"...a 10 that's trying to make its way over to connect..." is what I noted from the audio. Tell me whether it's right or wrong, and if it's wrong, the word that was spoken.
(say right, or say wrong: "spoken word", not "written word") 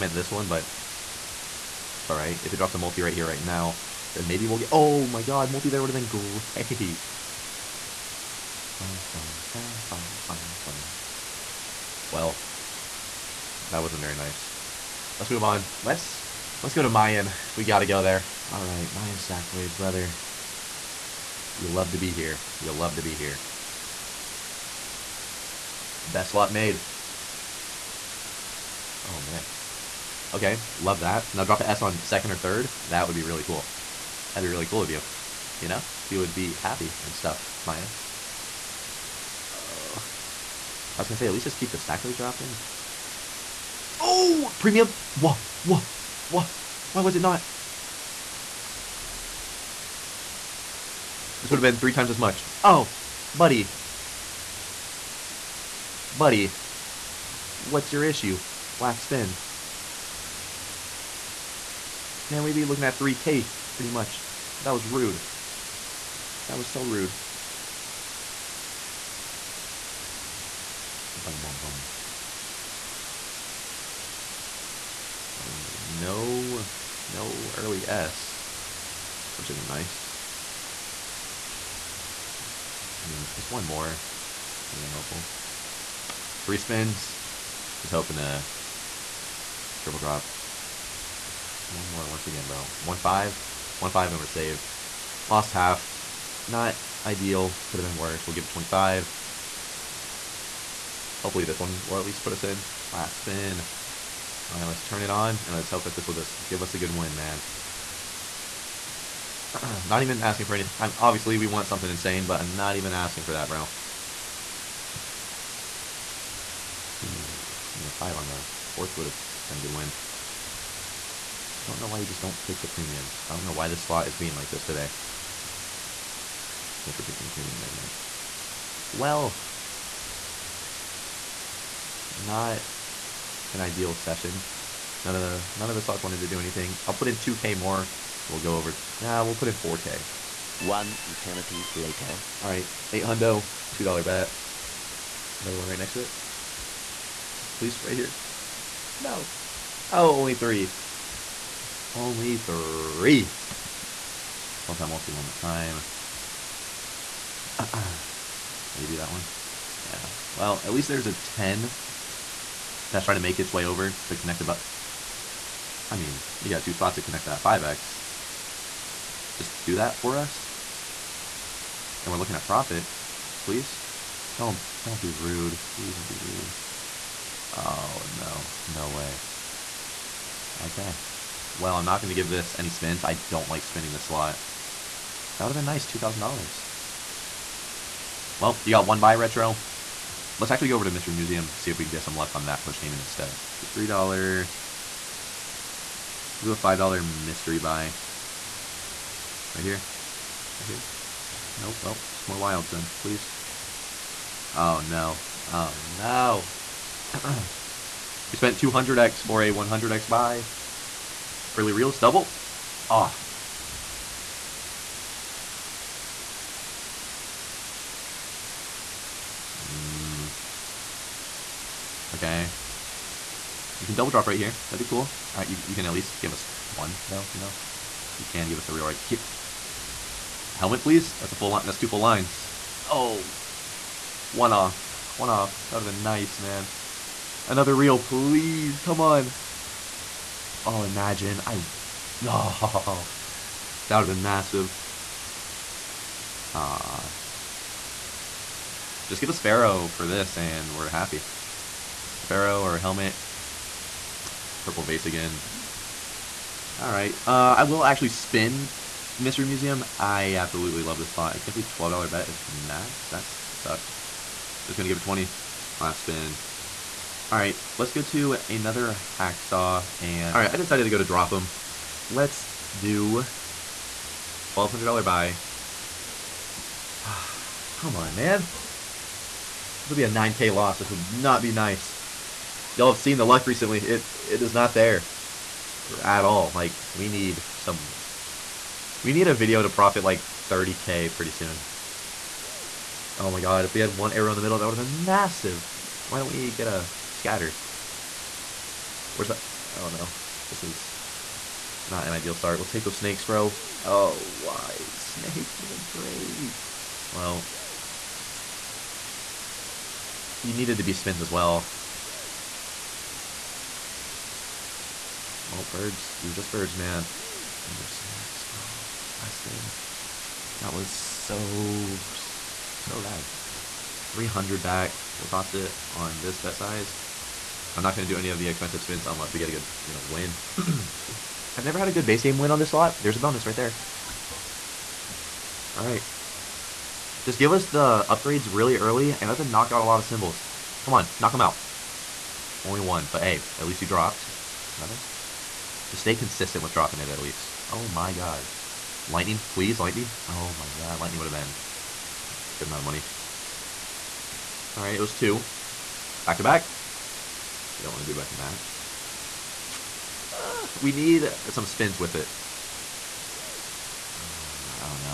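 right.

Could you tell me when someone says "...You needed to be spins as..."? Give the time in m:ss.
5:10.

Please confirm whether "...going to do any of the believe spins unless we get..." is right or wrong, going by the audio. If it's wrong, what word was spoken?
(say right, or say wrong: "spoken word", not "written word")
wrong: "expensive", not "believe".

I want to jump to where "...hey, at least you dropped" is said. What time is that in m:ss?
5:43.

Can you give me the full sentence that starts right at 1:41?
Hopefully this one will at least put us in.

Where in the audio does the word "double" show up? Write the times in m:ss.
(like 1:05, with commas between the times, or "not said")
3:31, 3:43.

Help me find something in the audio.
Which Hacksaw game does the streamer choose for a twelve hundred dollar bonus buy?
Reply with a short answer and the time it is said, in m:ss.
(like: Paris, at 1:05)
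Dropem, at 4:31.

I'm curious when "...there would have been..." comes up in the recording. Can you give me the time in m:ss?
0:05.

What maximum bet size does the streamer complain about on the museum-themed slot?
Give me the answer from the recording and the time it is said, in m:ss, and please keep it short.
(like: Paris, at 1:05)
$12, at 4:21.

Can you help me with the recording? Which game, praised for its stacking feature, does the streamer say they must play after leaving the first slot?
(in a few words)
Mayan Stackways.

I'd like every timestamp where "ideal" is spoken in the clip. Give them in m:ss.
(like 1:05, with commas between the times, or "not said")
1:37, 2:13, 5:02.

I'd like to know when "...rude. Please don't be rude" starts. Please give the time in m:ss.
2:55.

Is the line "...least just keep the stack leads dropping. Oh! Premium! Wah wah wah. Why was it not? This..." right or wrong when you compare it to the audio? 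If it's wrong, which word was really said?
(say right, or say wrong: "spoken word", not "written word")
right.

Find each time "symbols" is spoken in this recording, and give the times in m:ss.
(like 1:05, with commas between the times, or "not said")
5:40.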